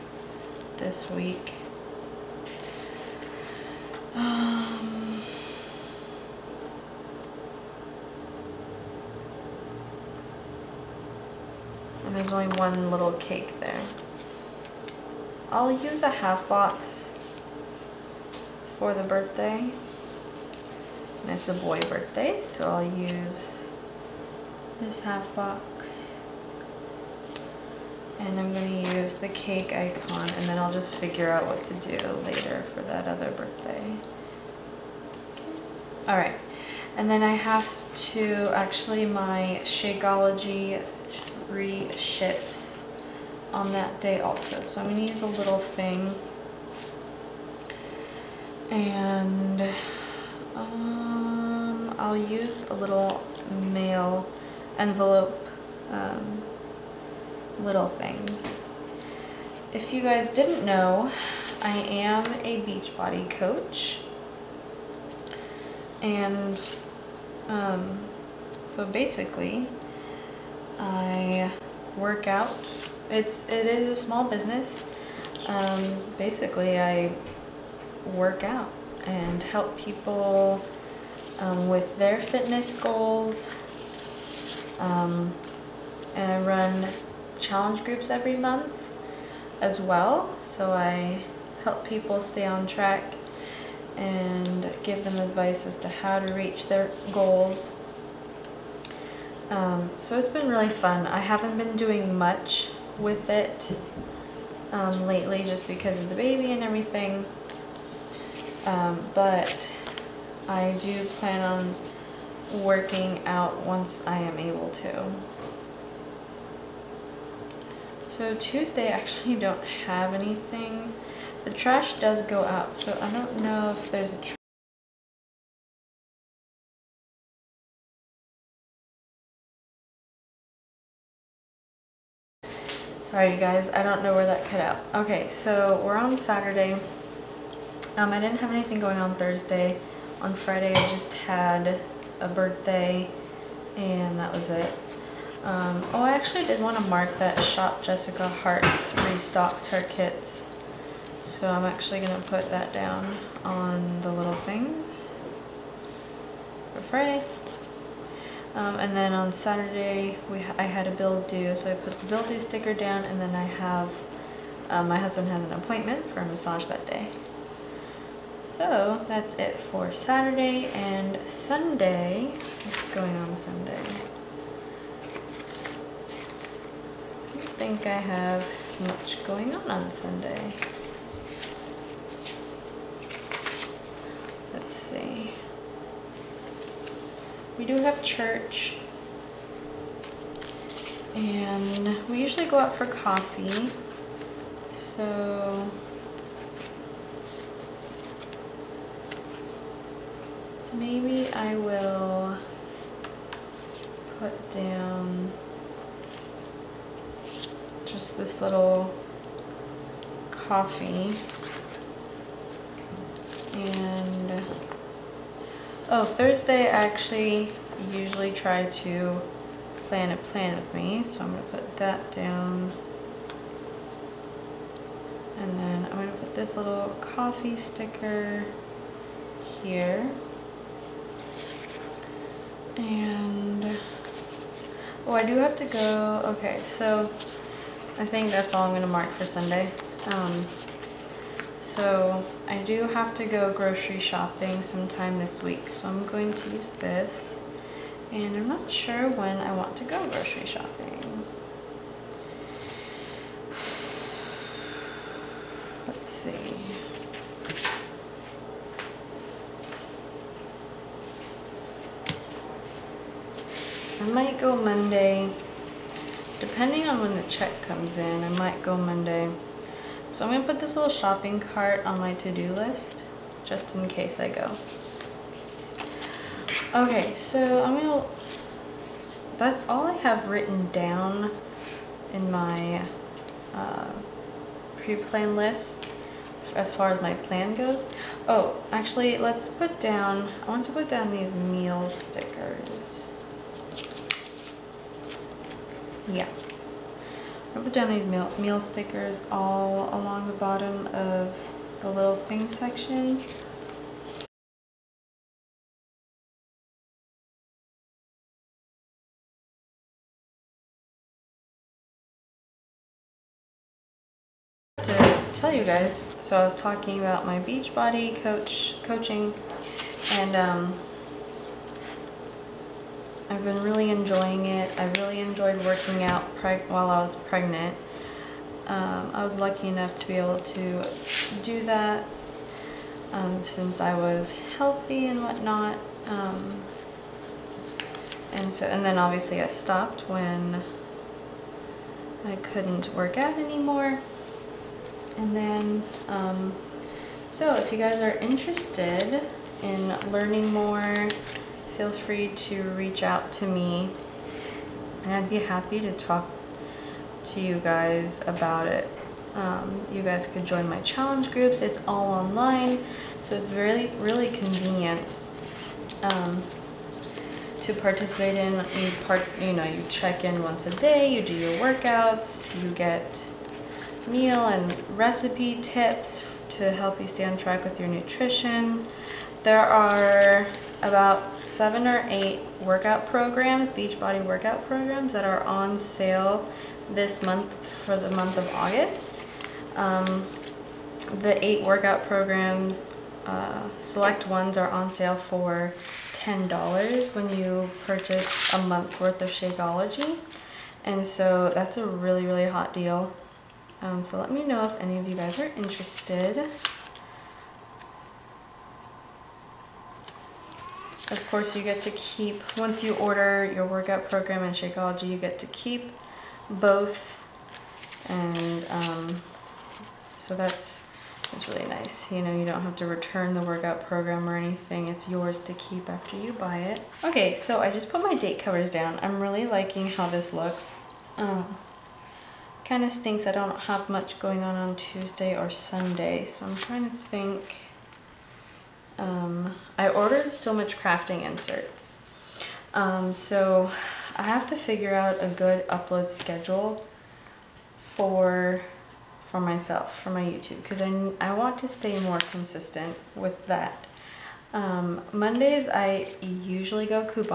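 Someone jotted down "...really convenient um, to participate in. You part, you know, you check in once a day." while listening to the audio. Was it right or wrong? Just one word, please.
right.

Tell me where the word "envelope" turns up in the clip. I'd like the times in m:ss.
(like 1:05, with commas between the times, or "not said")
0:54.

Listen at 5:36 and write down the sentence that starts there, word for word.
Um, and so, and then obviously I stopped when I couldn't work out anymore.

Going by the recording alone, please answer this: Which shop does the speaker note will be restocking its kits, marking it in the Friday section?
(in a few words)
Shop Jessica Hart.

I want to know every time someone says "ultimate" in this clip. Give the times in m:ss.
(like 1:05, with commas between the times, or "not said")
not said.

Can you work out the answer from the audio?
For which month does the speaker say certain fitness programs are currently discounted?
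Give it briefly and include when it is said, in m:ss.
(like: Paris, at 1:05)
August, at 6:28.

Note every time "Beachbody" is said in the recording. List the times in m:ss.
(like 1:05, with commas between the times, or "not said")
1:02, 5:17, 6:23.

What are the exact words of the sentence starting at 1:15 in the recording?
Um, basically, I work out and help people um, with their fitness goals.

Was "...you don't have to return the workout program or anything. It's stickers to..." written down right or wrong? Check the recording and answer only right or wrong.
wrong.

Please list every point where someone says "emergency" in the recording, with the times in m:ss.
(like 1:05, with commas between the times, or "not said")
not said.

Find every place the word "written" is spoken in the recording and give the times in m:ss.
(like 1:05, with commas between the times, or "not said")
4:40.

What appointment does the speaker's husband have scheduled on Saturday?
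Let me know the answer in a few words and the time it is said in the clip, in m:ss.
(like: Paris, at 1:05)
massage, at 2:46.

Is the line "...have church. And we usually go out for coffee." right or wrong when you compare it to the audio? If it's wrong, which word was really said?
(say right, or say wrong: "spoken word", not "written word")
right.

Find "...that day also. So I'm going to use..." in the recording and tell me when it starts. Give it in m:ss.
0:43.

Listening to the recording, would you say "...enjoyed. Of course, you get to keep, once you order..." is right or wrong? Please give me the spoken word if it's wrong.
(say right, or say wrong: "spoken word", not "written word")
wrong: "interested", not "enjoyed".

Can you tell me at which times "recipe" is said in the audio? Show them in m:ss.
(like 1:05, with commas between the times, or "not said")
6:14.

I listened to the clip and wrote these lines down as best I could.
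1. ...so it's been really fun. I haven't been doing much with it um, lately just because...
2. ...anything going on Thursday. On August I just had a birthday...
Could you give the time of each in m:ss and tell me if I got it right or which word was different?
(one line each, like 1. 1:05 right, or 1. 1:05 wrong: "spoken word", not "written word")
1. 1:39 right
2. 2:18 wrong: "Friday", not "August".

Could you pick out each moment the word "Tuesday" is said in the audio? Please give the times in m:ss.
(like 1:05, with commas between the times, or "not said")
1:58, 7:14.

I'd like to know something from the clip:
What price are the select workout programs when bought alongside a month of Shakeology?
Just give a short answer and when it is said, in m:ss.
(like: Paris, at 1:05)
$10, at 6:36.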